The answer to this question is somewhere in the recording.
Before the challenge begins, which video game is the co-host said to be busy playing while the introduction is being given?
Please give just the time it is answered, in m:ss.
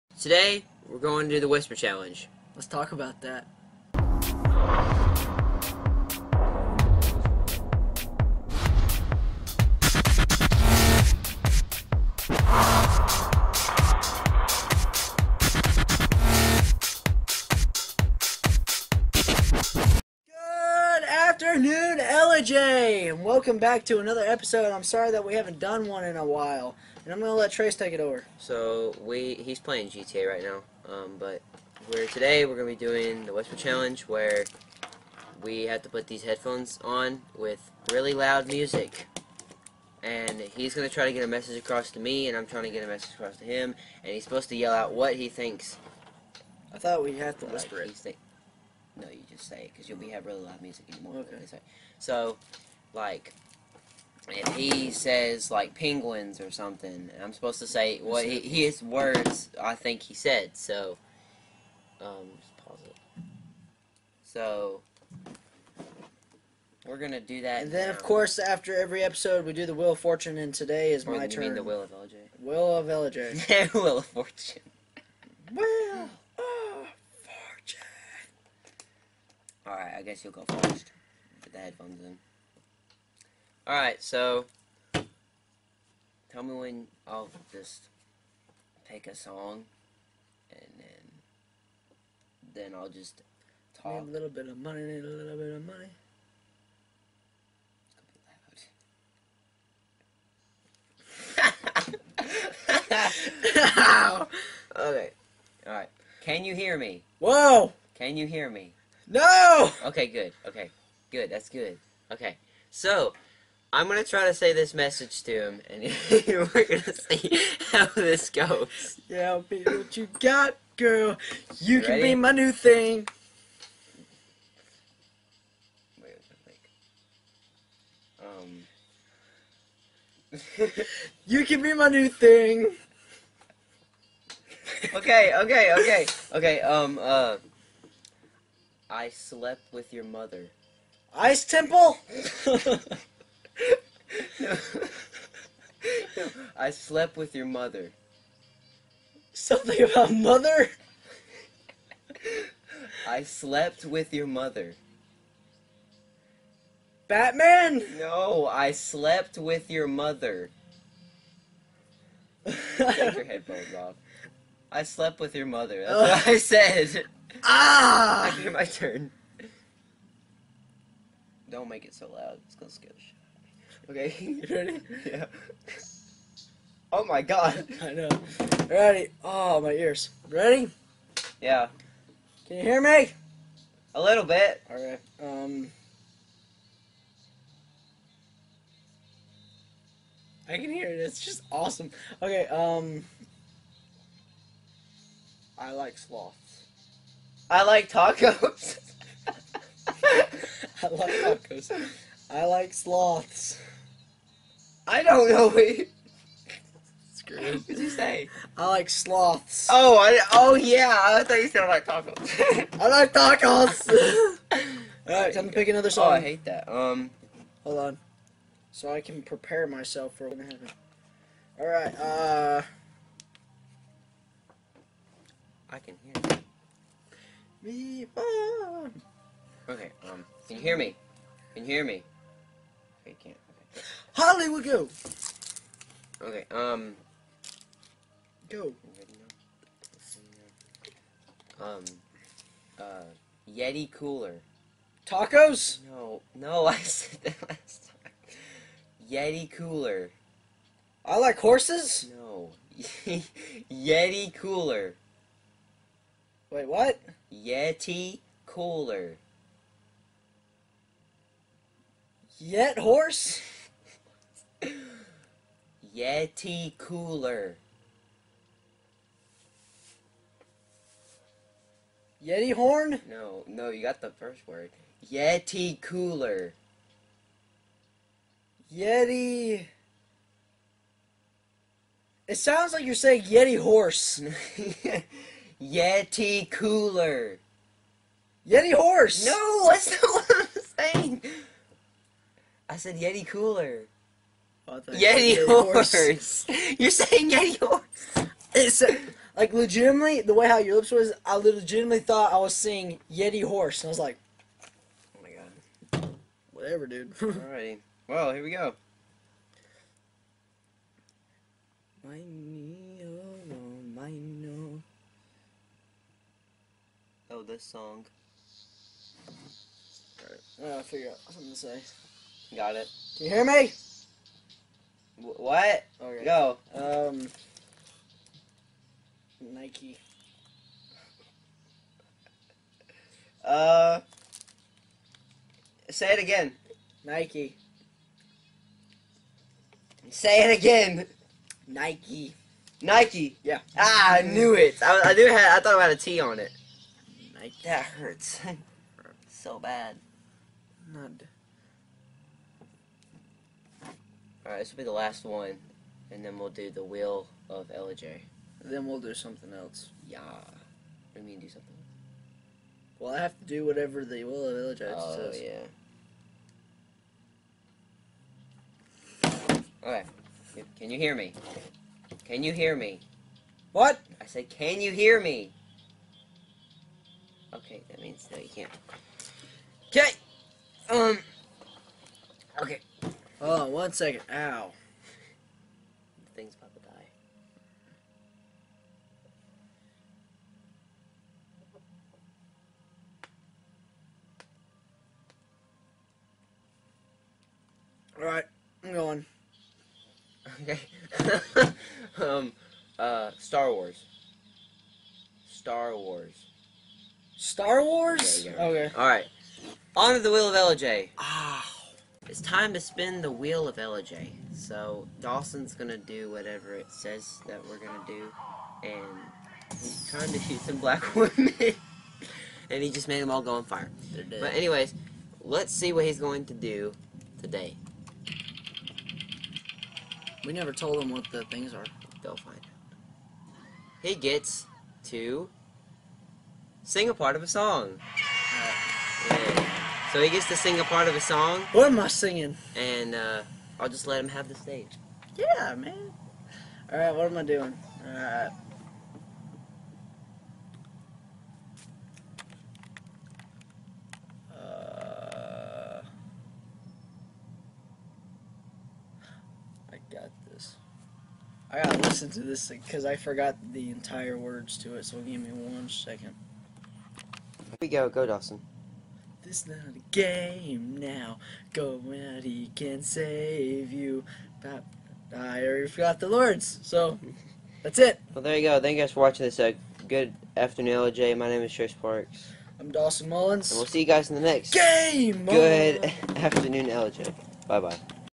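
0:29.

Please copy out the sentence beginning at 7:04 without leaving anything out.
But anyways, let's see what he's going to do today.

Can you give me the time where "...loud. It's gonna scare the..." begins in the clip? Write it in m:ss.
2:52.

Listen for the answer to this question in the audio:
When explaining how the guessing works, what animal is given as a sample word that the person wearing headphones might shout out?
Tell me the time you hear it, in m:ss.
0:55.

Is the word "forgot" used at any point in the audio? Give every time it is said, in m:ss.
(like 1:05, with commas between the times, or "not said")
7:43, 7:55.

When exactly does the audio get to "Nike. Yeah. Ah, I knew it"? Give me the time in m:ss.
5:42.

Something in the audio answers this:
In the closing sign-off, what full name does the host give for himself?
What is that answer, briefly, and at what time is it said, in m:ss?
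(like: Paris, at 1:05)
Trace Parks, at 8:01.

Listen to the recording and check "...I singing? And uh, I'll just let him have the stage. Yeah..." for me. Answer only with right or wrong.
right.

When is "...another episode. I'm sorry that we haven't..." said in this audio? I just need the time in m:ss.
0:23.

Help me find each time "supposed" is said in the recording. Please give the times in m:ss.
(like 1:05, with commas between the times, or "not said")
0:44, 0:57.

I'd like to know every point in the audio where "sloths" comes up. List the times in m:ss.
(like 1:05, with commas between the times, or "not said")
3:15, 3:22, 3:28.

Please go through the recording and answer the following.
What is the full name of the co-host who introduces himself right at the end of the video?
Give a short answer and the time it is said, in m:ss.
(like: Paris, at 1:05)
Dawson Mullins, at 8:02.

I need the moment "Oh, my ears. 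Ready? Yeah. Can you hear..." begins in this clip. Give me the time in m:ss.
2:59.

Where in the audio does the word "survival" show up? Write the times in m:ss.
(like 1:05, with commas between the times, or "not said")
not said.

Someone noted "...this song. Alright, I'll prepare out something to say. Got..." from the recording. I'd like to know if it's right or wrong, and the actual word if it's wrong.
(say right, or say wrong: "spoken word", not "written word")
wrong: "figure", not "prepare".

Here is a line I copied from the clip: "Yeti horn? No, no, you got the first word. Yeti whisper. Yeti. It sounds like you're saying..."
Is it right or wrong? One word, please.
wrong.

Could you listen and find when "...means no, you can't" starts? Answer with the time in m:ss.
6:18.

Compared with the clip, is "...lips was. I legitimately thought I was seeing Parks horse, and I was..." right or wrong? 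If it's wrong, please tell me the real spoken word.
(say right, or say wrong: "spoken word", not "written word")
wrong: "Yeti", not "Parks".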